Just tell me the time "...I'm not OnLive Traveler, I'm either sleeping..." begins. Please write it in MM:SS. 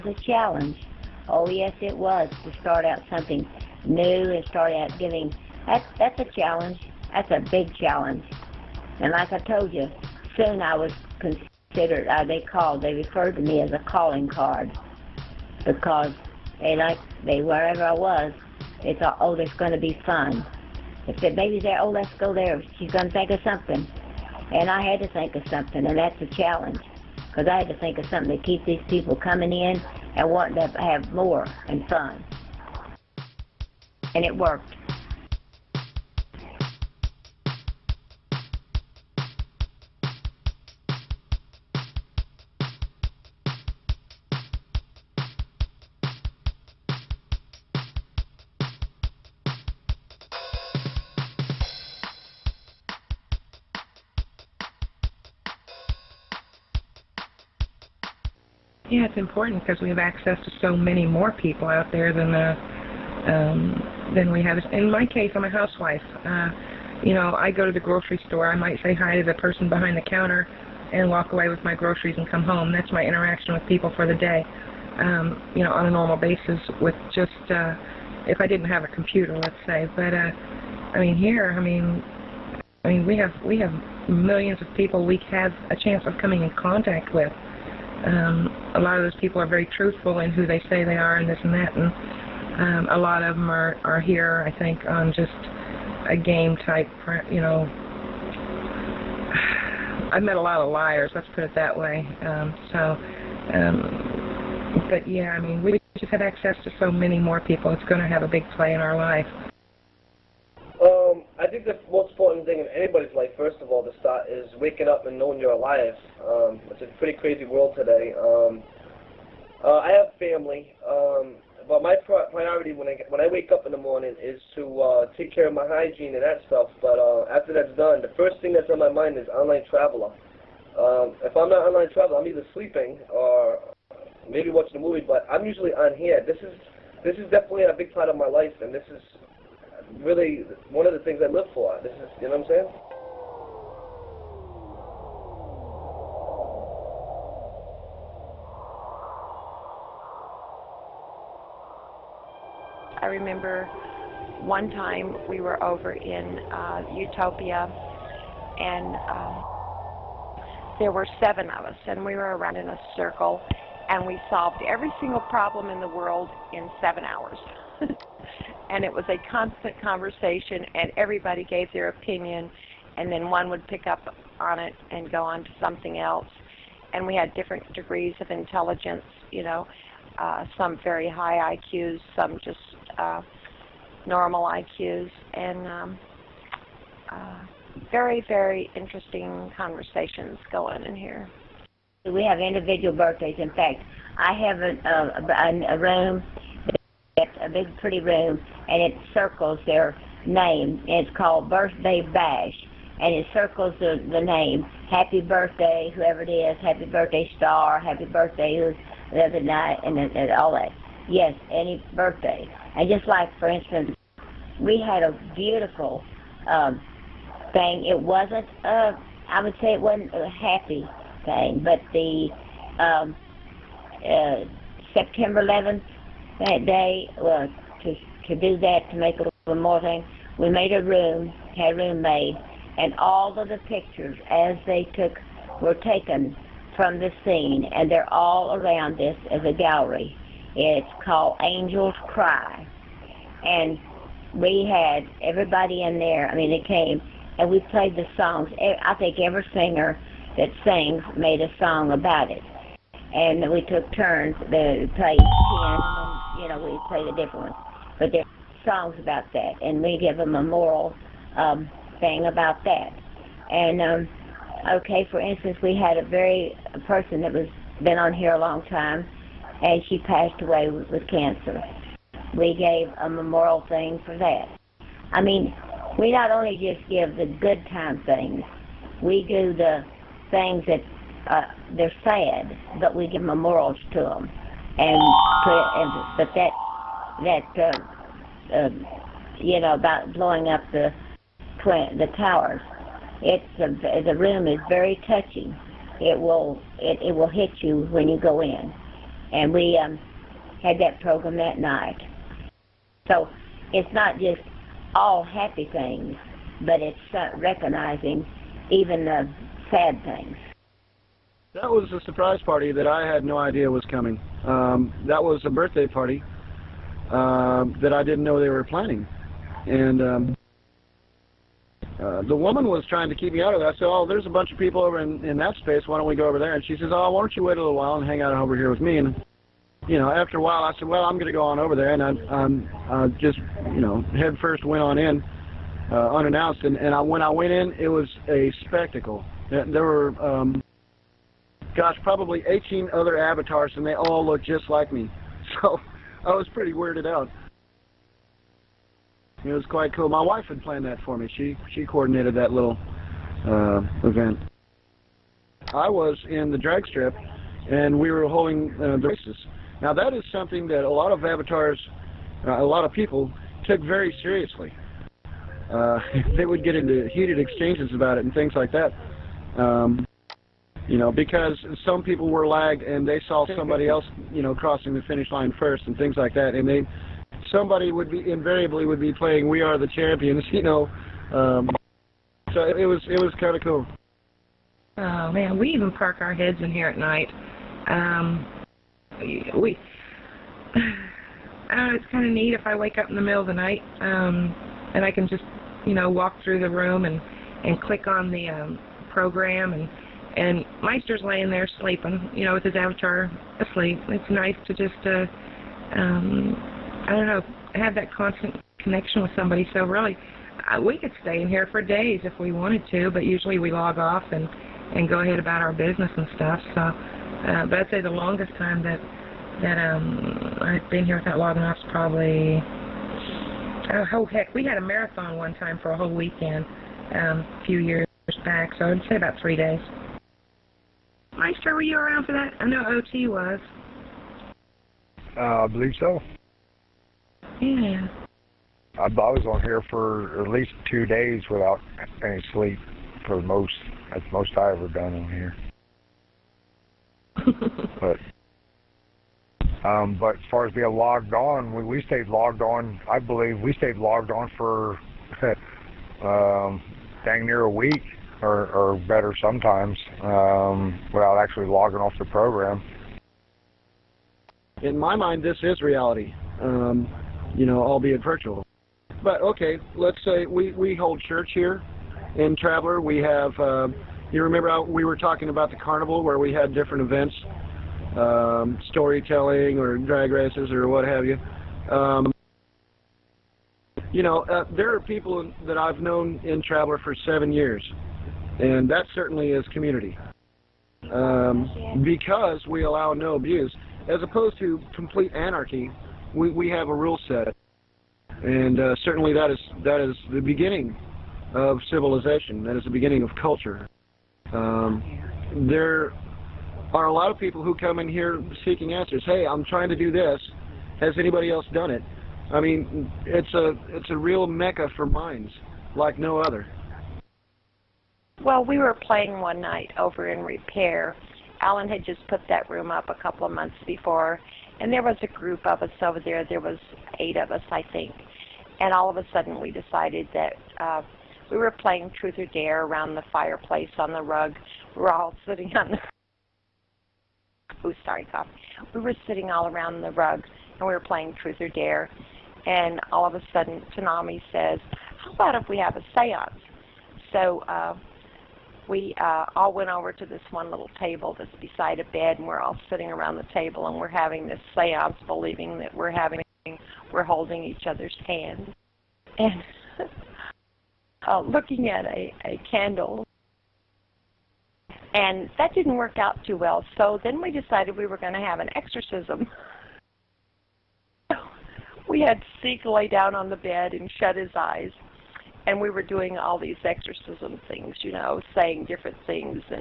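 02:11.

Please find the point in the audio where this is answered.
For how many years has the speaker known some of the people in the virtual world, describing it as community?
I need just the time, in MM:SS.
08:07.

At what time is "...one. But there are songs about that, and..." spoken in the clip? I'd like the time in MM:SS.
04:17.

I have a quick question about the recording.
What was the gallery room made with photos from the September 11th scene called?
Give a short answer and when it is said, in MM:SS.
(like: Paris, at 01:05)
Angels Cry, at 04:01.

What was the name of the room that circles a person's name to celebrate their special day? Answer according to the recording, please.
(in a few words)
Birthday Bash.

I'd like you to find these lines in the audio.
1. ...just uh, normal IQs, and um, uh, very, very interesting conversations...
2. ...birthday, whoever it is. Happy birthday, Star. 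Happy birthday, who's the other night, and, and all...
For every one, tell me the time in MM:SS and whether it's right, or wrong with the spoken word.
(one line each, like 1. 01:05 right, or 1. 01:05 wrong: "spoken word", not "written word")
1. 03:02 right
2. 03:25 right.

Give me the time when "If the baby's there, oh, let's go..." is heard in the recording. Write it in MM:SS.
00:21.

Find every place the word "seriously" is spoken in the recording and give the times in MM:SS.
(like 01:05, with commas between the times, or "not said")
06:04.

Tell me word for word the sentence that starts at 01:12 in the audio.
That's my interaction with people for the day.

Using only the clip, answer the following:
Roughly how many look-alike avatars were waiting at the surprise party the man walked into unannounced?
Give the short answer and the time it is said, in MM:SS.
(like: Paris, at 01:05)
18, at 05:42.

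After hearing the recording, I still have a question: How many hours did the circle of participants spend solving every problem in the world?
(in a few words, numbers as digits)
7.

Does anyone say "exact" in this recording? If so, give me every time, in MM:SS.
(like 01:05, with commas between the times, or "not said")
not said.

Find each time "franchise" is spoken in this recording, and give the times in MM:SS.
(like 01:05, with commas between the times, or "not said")
not said.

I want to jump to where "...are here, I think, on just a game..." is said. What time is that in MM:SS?
01:33.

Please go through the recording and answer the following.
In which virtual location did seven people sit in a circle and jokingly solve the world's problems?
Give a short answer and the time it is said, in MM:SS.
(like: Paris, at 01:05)
Utopia, at 02:36.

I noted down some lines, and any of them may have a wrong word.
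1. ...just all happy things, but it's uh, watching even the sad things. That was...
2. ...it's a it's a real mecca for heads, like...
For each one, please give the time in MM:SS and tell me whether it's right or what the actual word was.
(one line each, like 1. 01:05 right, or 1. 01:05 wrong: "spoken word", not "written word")
1. 05:04 wrong: "recognizing", not "watching"
2. 08:33 wrong: "minds", not "heads".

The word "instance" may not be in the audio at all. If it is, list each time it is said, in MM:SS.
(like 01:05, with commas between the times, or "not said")
03:33, 04:25.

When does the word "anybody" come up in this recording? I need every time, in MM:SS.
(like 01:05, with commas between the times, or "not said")
01:52, 08:31.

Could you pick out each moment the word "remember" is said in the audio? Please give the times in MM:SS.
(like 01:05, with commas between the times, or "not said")
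02:33, 07:54.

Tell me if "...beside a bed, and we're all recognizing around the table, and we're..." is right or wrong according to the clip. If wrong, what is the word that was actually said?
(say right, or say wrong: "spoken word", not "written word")
wrong: "sitting", not "recognizing".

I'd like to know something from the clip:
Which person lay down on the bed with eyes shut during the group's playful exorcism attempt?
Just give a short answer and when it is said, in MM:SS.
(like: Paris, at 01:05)
Seek, at 09:32.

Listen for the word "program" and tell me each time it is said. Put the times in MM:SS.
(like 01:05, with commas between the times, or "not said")
05:01, 06:39, 07:42.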